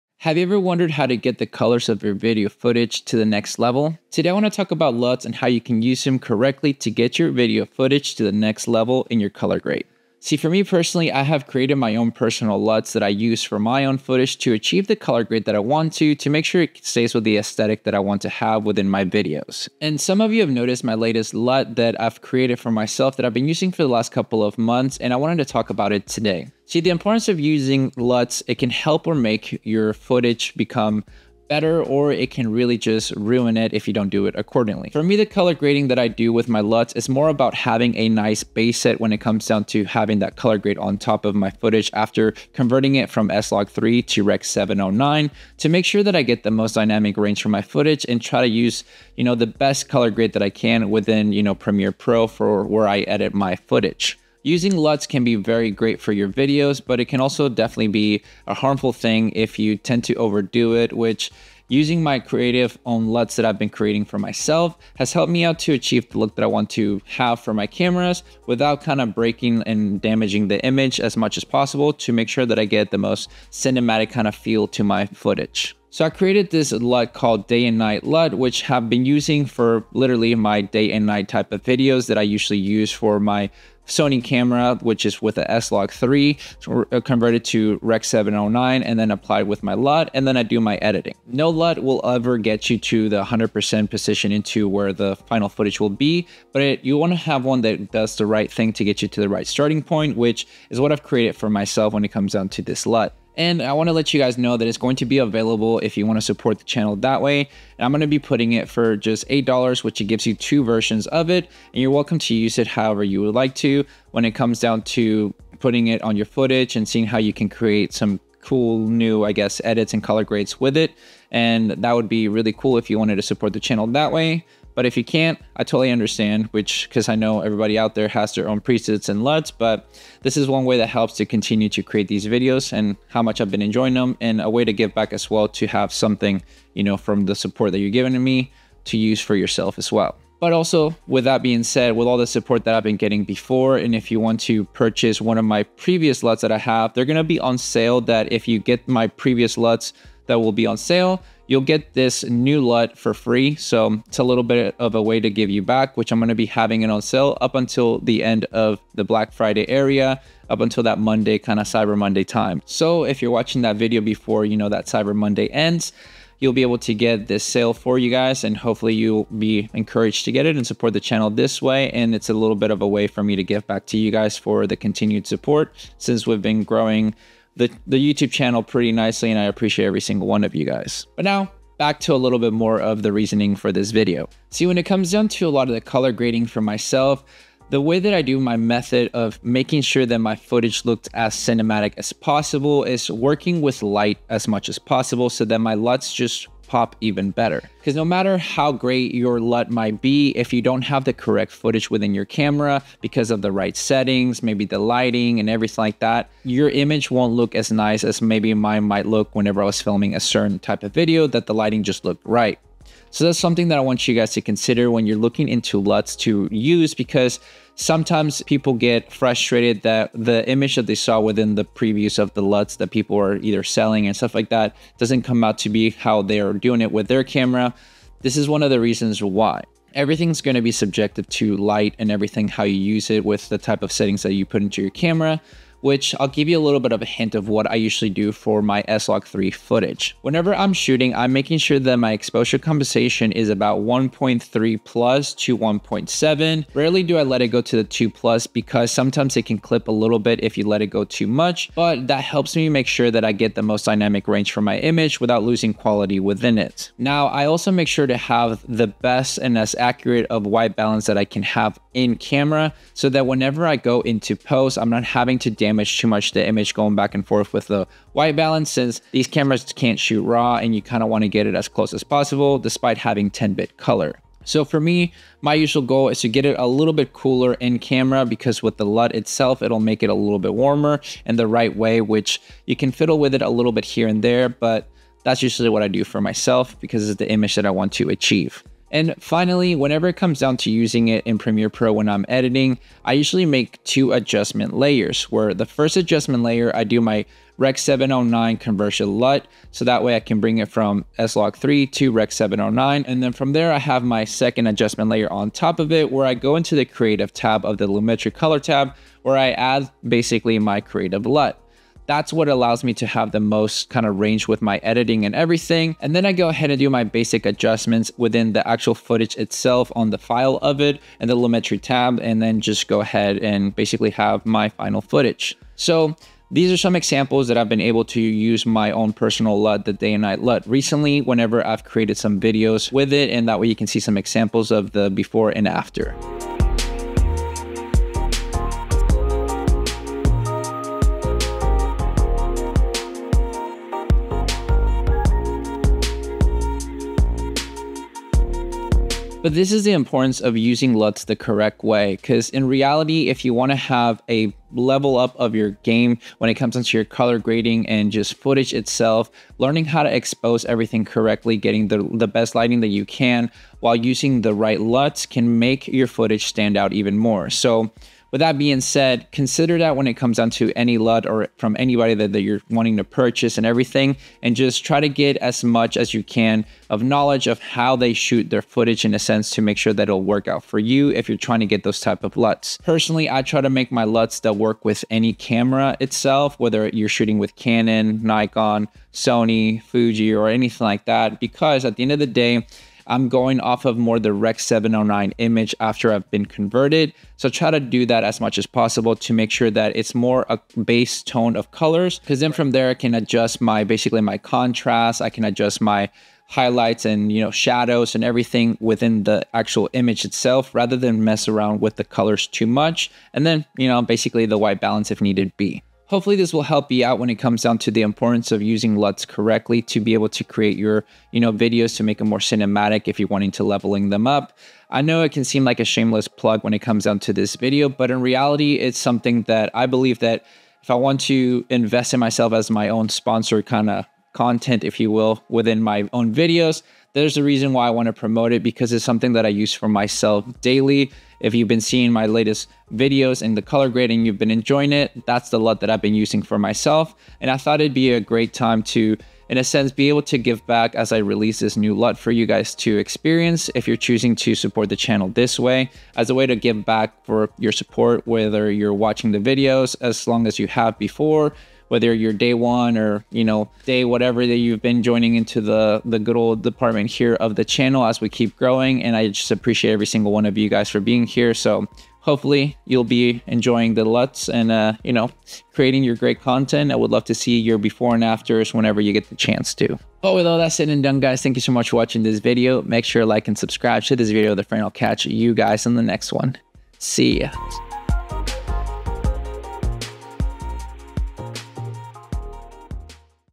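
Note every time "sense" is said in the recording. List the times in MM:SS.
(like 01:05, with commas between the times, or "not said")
06:19, 07:29.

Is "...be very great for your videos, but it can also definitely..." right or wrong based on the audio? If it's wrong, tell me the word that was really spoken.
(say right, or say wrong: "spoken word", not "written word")
right.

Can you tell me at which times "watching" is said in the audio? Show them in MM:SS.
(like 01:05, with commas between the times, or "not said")
02:43, 07:38, 08:01.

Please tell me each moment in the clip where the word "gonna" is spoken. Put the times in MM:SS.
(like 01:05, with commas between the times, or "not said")
02:27, 02:36.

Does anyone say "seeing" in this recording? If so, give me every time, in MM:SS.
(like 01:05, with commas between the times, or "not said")
01:56, 07:21.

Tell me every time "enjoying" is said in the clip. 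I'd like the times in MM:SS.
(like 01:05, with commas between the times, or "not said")
02:13, 07:24, 07:53.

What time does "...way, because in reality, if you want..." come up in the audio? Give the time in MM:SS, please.
05:51.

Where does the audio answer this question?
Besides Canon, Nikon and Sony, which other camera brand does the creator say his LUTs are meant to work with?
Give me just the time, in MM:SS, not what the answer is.
06:29.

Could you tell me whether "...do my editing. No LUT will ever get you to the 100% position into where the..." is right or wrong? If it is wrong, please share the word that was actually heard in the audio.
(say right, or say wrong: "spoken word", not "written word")
right.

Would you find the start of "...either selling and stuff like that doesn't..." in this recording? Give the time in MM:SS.
03:43.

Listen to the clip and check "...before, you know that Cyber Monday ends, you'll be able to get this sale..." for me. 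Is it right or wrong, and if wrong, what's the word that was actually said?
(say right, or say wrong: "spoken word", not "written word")
right.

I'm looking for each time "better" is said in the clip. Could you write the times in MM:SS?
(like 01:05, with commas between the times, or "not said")
00:31, 03:17.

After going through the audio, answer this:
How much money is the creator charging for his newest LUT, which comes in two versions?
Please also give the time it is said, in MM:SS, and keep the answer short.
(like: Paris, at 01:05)
$8, at 01:49.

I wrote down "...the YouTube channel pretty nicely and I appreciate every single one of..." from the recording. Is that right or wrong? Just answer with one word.
right.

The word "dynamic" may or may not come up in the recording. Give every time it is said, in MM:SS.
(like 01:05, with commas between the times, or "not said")
00:46, 04:13.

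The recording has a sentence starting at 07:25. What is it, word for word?
That's the LUT that I've been using for myself.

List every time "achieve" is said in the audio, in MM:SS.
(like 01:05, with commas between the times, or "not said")
00:14, 01:05, 04:48.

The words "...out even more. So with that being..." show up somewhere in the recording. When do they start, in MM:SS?
06:06.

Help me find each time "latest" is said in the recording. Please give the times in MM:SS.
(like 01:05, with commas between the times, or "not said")
00:20, 07:22.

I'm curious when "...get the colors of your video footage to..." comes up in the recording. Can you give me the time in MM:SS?
00:01.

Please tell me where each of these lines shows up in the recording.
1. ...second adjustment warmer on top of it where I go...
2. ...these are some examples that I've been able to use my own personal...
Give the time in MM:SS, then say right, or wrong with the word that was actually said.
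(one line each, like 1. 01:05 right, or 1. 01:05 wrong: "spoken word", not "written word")
1. 05:04 wrong: "layer", not "warmer"
2. 05:26 right.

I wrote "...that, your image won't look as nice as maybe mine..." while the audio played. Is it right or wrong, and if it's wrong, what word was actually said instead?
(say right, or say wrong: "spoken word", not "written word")
right.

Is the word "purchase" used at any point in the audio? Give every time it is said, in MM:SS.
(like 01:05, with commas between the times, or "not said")
02:24, 06:13.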